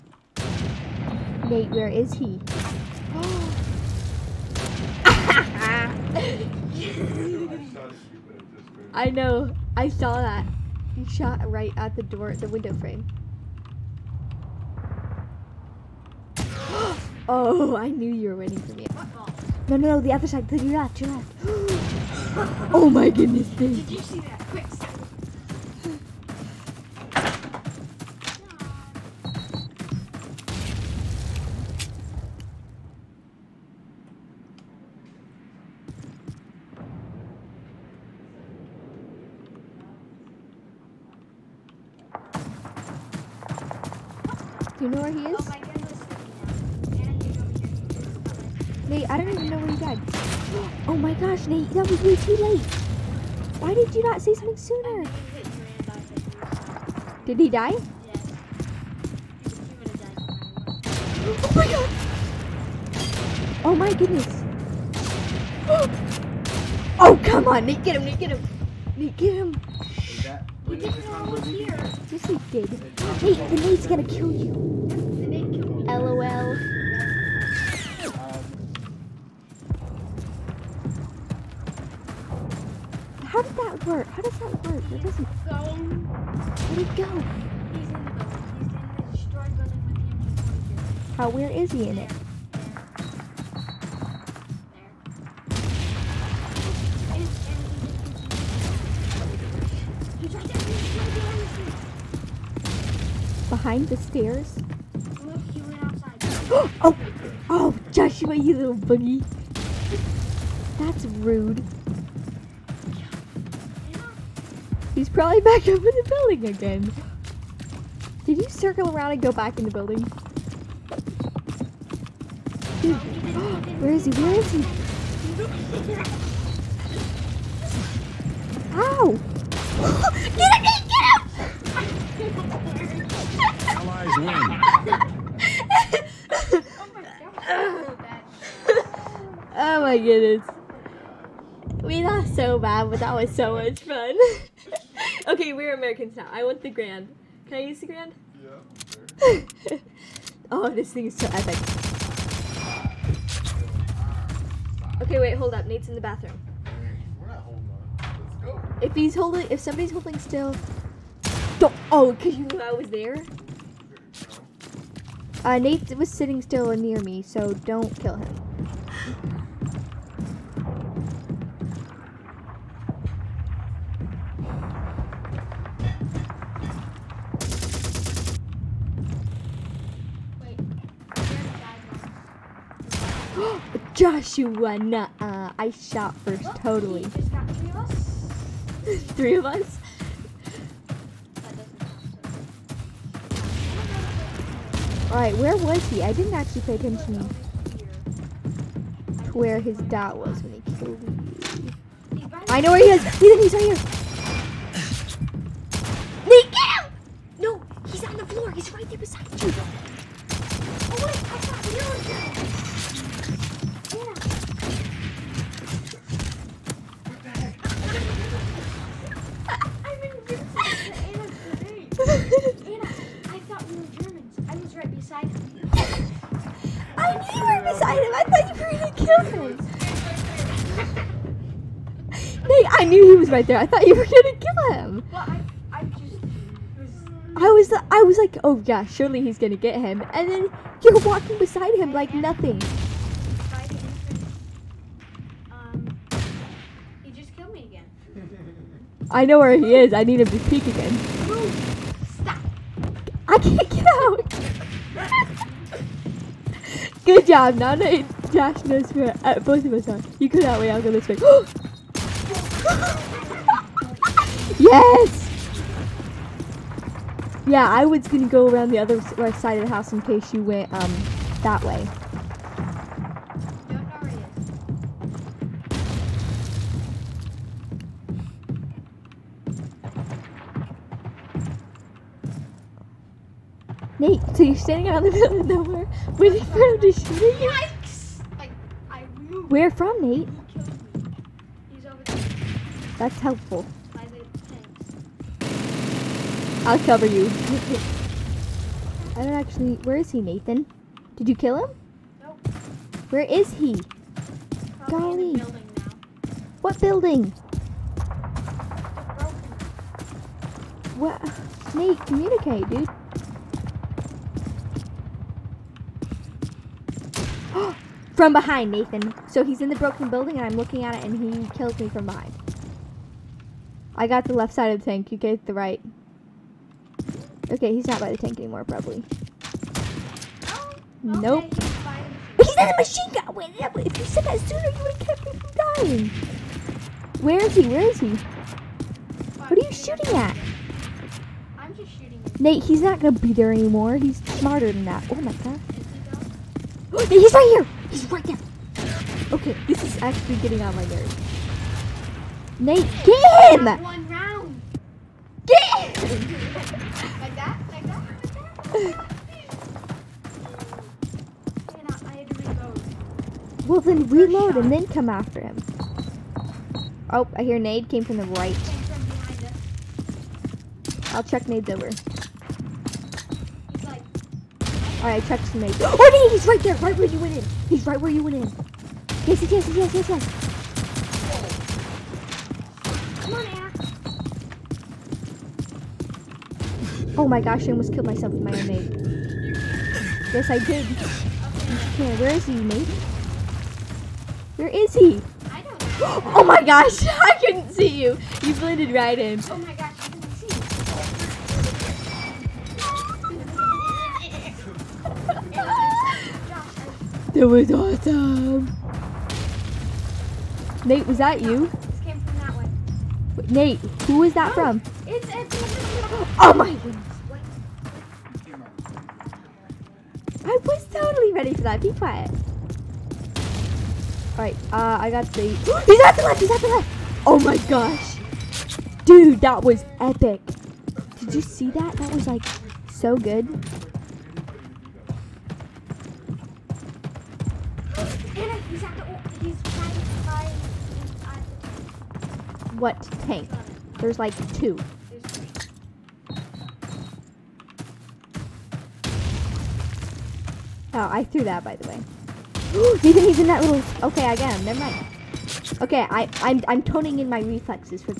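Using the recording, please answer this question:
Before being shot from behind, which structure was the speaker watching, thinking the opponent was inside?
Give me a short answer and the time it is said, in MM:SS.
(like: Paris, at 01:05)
broken building, at 05:19.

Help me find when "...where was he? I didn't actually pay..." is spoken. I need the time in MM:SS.
03:15.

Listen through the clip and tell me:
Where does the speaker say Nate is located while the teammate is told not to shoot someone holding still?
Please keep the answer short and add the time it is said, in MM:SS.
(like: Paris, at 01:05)
in the bathroom, at 02:35.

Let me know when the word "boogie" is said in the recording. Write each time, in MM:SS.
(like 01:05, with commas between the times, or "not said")
01:48.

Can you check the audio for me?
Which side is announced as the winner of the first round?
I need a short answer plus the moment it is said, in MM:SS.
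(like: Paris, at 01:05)
Allies, at 02:13.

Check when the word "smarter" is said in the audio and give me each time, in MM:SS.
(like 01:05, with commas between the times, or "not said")
05:44.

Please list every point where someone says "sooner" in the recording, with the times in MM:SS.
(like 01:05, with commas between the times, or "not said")
00:54, 05:34.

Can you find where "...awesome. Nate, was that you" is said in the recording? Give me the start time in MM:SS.
06:47.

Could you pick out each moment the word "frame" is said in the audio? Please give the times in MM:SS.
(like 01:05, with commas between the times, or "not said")
00:12.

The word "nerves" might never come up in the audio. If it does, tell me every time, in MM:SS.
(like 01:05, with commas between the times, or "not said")
05:50.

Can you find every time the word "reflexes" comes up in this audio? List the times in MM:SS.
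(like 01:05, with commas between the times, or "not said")
07:37.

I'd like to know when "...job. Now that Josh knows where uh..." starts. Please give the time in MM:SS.
04:17.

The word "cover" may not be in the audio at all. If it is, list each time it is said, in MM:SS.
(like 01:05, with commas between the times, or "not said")
04:56.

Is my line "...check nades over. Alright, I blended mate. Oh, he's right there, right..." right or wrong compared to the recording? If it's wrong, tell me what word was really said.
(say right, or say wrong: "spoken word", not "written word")
wrong: "checked", not "blended".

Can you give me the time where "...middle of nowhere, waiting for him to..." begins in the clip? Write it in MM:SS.
04:45.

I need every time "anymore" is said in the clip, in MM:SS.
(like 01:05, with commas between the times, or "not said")
05:28, 05:43.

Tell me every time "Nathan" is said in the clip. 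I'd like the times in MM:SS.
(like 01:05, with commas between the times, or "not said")
05:00, 05:18.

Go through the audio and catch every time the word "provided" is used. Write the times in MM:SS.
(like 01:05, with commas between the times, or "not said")
not said.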